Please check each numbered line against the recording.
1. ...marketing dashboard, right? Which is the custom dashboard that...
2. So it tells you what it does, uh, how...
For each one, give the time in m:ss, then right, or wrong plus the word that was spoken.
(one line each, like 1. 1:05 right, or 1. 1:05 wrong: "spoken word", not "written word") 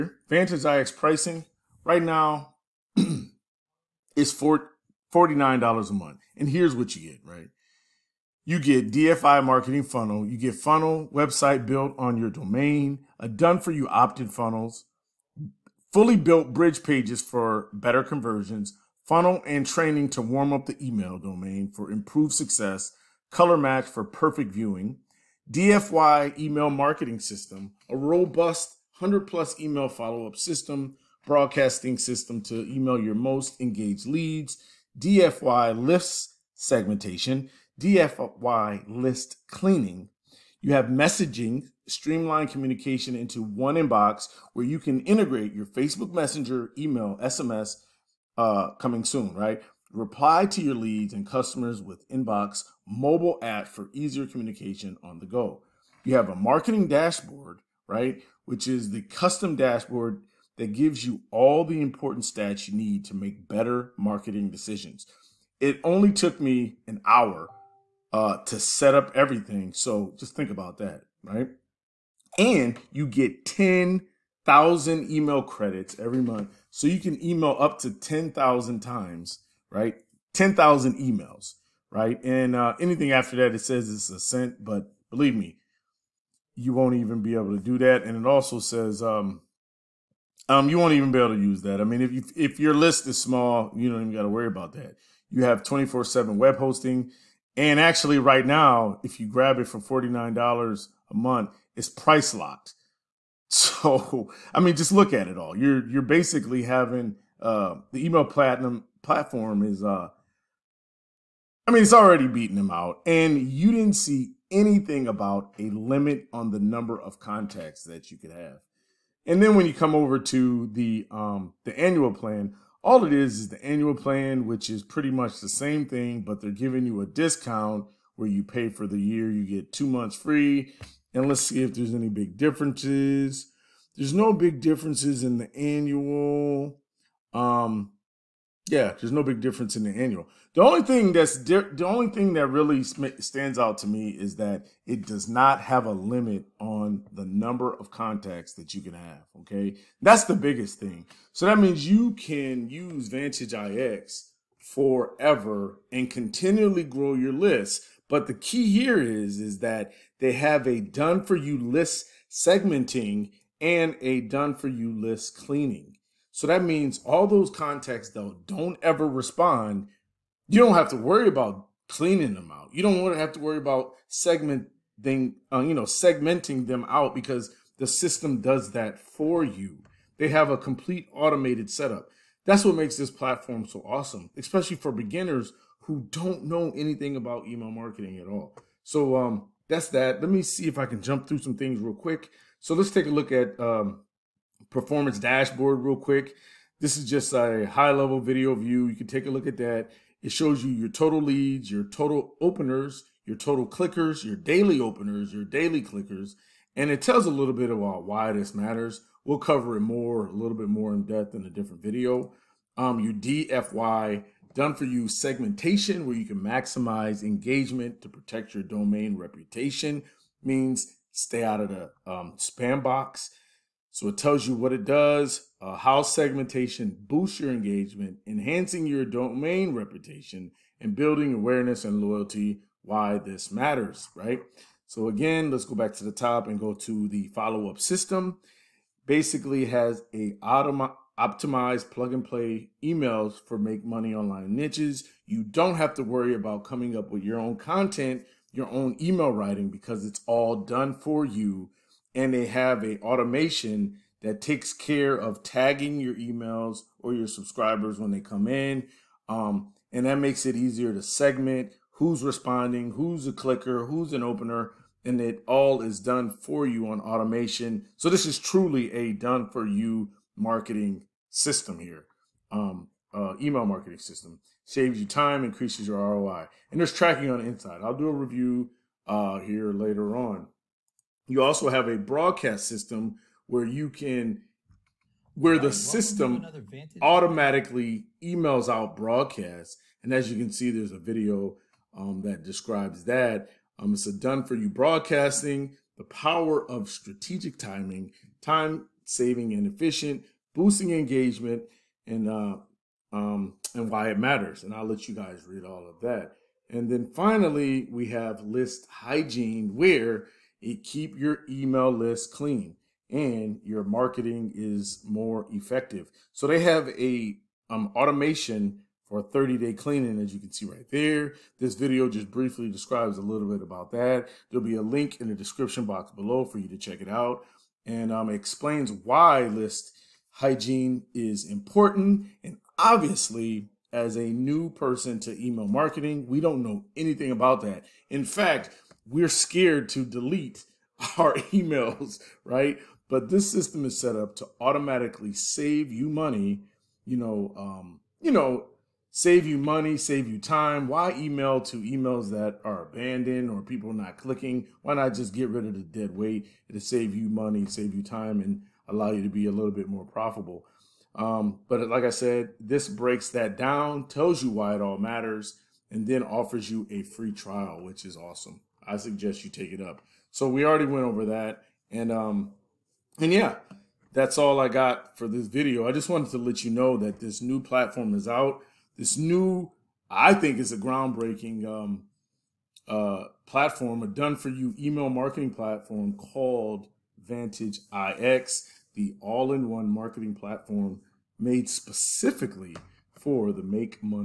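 1. 0:56 right
2. 3:43 right.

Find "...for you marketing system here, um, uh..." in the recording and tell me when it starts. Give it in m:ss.
4:29.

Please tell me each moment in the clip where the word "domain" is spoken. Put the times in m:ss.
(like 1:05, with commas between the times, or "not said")
0:12, 0:21, 3:38, 3:49.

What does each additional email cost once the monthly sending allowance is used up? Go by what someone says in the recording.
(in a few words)
a cent.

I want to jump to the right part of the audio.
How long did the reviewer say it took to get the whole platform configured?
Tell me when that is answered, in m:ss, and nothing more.
1:06.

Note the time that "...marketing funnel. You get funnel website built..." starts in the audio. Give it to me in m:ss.
0:09.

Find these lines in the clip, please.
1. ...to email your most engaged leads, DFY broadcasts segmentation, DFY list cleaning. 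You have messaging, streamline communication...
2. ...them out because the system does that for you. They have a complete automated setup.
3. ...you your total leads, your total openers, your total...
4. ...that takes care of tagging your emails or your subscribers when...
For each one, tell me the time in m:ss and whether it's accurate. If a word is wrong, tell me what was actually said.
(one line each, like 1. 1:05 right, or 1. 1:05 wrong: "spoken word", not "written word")
1. 0:32 wrong: "lists", not "broadcasts"
2. 2:56 right
3. 3:20 right
4. 4:14 right.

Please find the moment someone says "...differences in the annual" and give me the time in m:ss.
2:14.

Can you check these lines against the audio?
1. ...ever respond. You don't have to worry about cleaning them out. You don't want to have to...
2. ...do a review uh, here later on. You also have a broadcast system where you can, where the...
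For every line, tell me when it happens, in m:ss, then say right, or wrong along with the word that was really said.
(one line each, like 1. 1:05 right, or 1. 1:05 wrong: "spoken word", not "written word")
1. 2:48 right
2. 4:37 right.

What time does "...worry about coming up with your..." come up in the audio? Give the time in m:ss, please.
4:06.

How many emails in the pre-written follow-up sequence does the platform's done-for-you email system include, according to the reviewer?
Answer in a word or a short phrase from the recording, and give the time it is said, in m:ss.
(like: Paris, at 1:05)
100+, at 0:28.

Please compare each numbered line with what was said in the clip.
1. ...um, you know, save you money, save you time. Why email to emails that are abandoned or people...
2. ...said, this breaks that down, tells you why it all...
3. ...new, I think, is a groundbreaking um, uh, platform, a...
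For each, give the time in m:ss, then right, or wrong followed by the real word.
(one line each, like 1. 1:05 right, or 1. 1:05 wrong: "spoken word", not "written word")
1. 5:47 right
2. 6:02 right
3. 6:19 right.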